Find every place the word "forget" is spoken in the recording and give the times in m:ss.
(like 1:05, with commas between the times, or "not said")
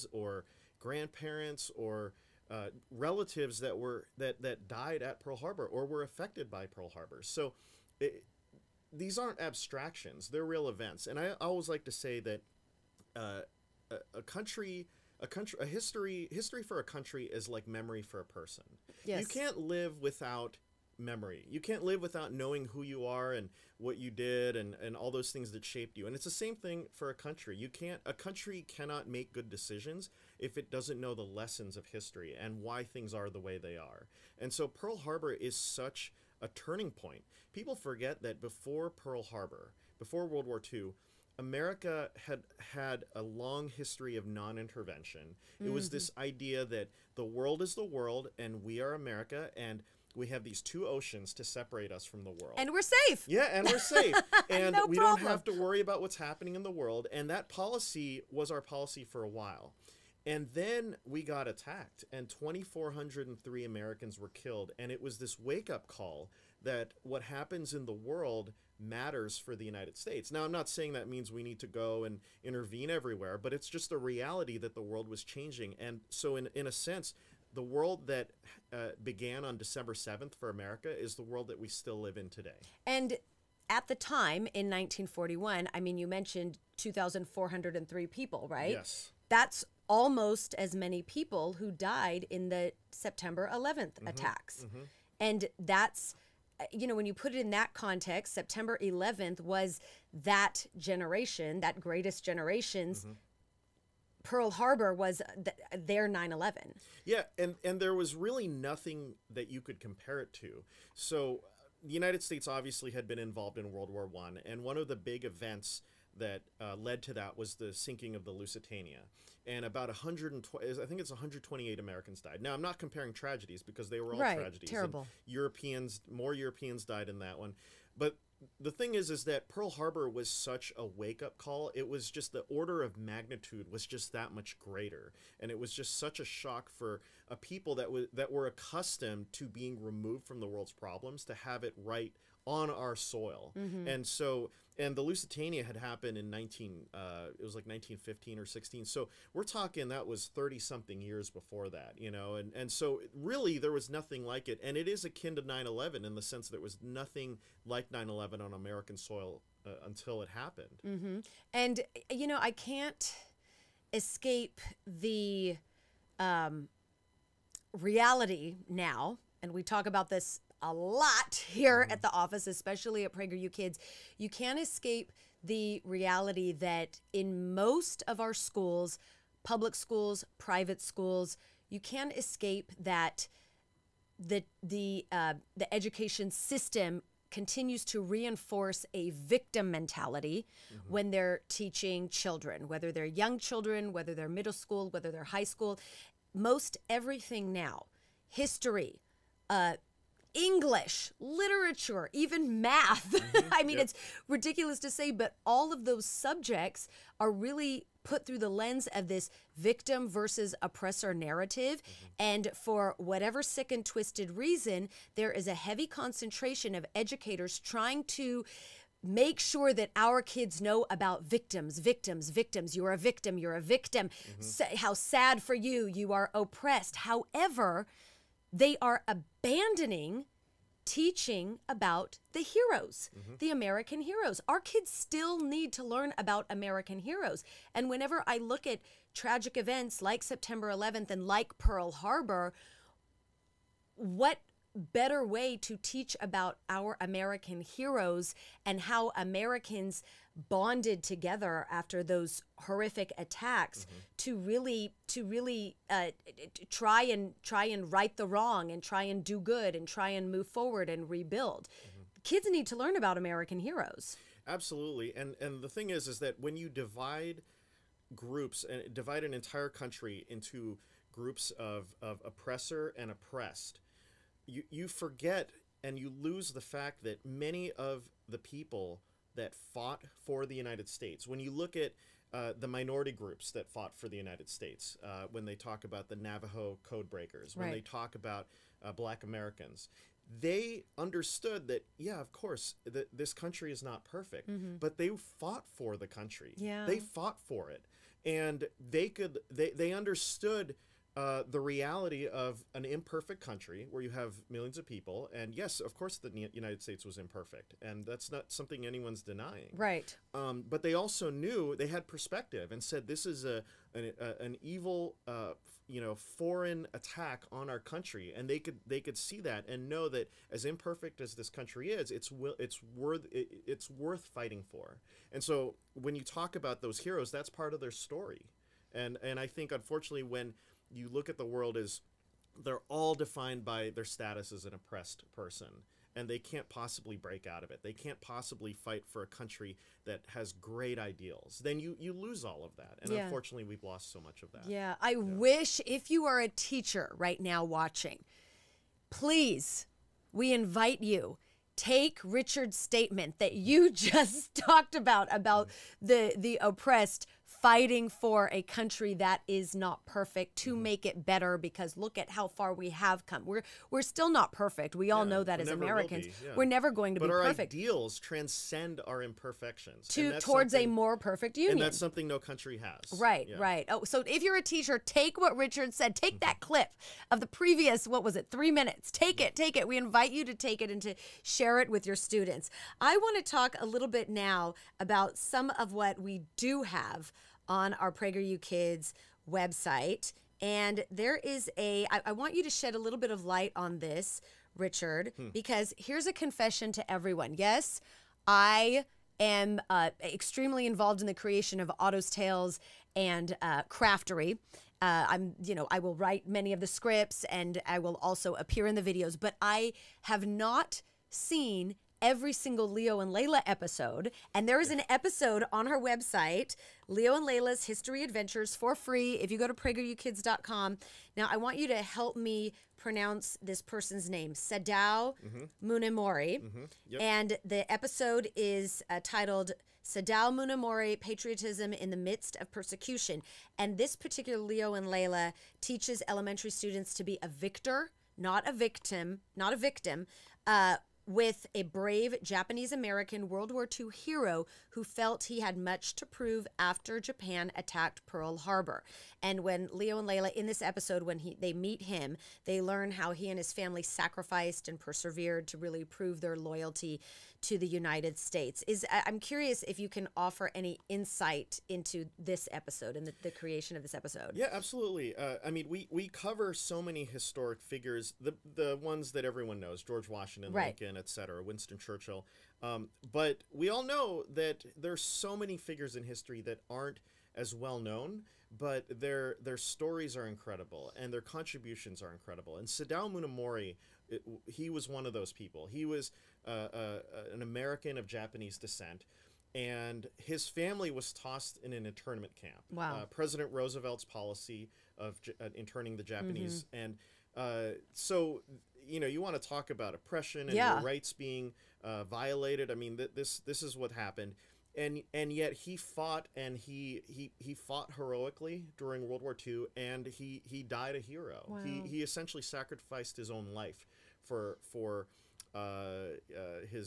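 0:37, 4:34.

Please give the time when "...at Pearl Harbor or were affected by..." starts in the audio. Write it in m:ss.
0:05.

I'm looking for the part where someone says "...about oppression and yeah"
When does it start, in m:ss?
8:19.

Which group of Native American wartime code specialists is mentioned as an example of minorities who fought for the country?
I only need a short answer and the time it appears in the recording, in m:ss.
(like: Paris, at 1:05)
Navajo code breakers, at 4:46.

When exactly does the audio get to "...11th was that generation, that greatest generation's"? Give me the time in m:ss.
1:38.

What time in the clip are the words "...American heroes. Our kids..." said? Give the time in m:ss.
3:53.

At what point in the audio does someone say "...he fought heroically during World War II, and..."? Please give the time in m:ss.
8:27.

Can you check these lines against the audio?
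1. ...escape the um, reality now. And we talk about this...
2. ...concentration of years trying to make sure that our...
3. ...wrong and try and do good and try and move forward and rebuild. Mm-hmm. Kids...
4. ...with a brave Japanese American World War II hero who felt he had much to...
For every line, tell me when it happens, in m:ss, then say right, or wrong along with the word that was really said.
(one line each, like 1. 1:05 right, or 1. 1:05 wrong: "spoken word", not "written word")
1. 2:43 right
2. 3:35 wrong: "educators", not "years"
3. 4:18 right
4. 7:21 right.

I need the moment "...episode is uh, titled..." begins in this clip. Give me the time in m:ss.
7:07.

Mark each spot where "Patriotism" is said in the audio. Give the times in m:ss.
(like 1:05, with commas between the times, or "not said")
7:11.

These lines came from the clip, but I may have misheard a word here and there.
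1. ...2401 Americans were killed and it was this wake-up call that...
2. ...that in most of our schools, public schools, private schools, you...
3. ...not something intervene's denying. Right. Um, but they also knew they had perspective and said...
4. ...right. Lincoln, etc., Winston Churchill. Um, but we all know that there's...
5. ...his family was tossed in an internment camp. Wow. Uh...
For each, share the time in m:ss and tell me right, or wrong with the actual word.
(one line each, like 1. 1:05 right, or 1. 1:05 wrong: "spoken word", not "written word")
1. 1:02 wrong: "2403", not "2401"
2. 2:56 right
3. 5:08 wrong: "anyone", not "intervene"
4. 7:50 right
5. 8:10 right.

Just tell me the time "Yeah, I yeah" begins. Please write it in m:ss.
5:44.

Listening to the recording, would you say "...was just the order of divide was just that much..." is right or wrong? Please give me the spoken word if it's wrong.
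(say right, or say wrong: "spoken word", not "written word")
wrong: "magnitude", not "divide".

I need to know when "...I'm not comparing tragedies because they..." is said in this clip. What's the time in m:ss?
2:02.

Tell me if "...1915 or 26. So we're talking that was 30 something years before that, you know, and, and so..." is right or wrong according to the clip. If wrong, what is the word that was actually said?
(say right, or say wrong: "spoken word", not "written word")
wrong: "16", not "26".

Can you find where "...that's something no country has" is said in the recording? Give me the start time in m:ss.
6:11.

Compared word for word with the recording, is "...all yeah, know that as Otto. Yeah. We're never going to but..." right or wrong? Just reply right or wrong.
wrong.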